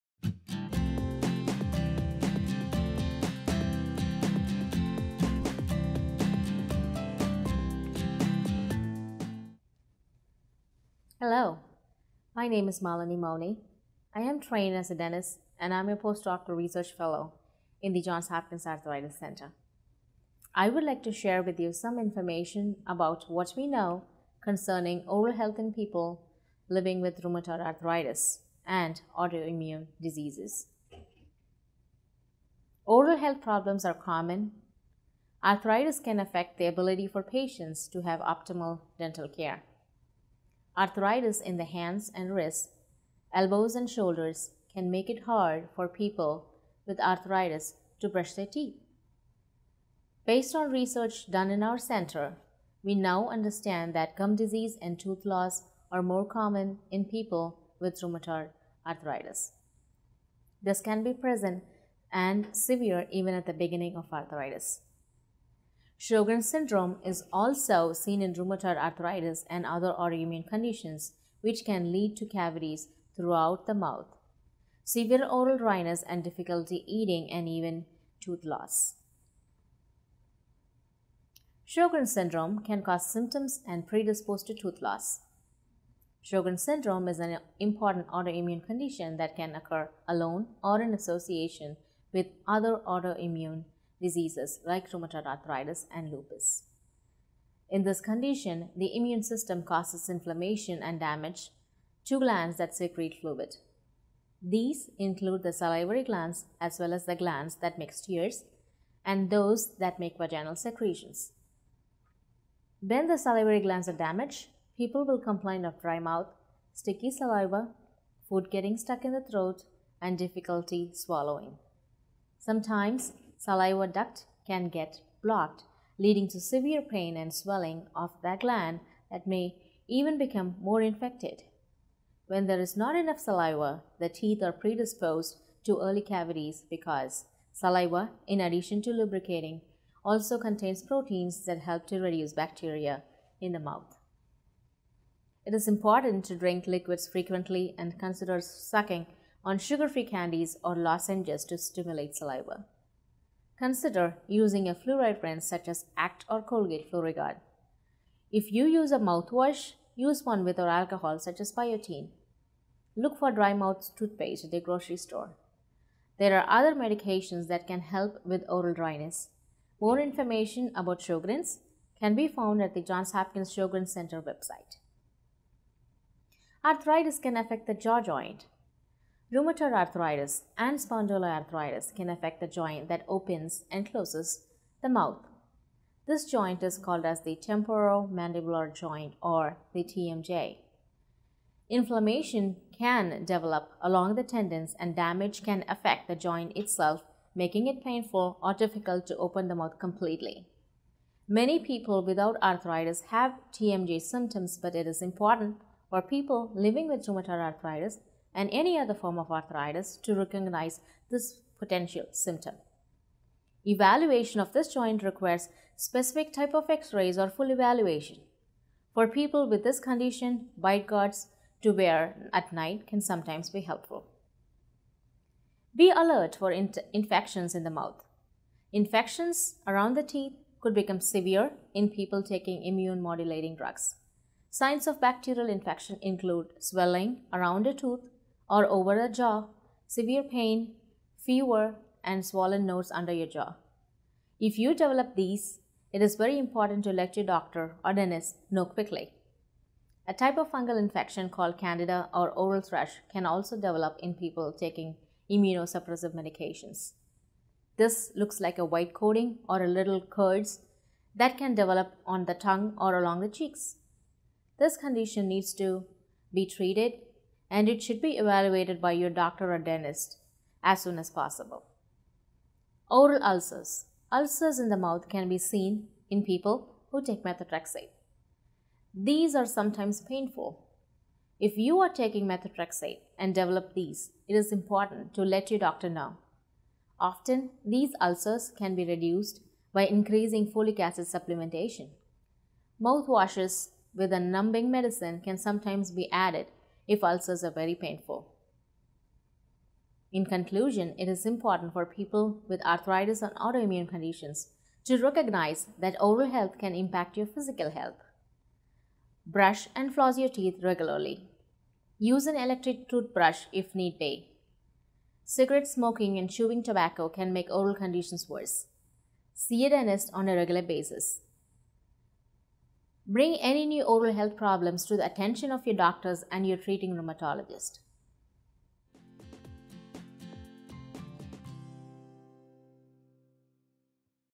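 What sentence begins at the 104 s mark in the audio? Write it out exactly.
These include the salivary glands as well as the glands that make tears and those that make vaginal secretions.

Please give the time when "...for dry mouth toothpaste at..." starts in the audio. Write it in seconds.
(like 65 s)
163 s.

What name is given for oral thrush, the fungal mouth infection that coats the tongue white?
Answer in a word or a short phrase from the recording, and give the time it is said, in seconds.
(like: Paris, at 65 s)
Candida, at 251 s.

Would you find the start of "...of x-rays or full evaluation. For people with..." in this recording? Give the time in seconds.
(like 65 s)
216 s.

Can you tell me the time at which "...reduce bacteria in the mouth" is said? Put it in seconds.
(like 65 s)
141 s.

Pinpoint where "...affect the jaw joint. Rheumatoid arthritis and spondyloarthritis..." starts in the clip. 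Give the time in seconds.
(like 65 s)
177 s.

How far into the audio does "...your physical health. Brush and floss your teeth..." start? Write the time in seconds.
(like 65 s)
307 s.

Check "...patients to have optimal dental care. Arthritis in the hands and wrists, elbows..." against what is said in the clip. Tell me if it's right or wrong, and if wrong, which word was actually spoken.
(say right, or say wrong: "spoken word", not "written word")
right.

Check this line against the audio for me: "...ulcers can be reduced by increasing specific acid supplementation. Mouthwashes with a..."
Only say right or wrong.
wrong.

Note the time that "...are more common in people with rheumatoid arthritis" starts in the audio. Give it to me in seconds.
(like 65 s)
55 s.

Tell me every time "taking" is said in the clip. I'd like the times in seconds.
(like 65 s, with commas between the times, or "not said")
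232 s, 254 s, 281 s.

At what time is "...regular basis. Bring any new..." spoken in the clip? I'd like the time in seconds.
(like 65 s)
320 s.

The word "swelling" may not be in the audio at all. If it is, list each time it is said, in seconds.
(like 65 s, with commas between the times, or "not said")
127 s, 236 s.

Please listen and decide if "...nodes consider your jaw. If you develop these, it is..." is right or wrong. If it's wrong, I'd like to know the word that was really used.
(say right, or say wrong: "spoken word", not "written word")
wrong: "under", not "consider".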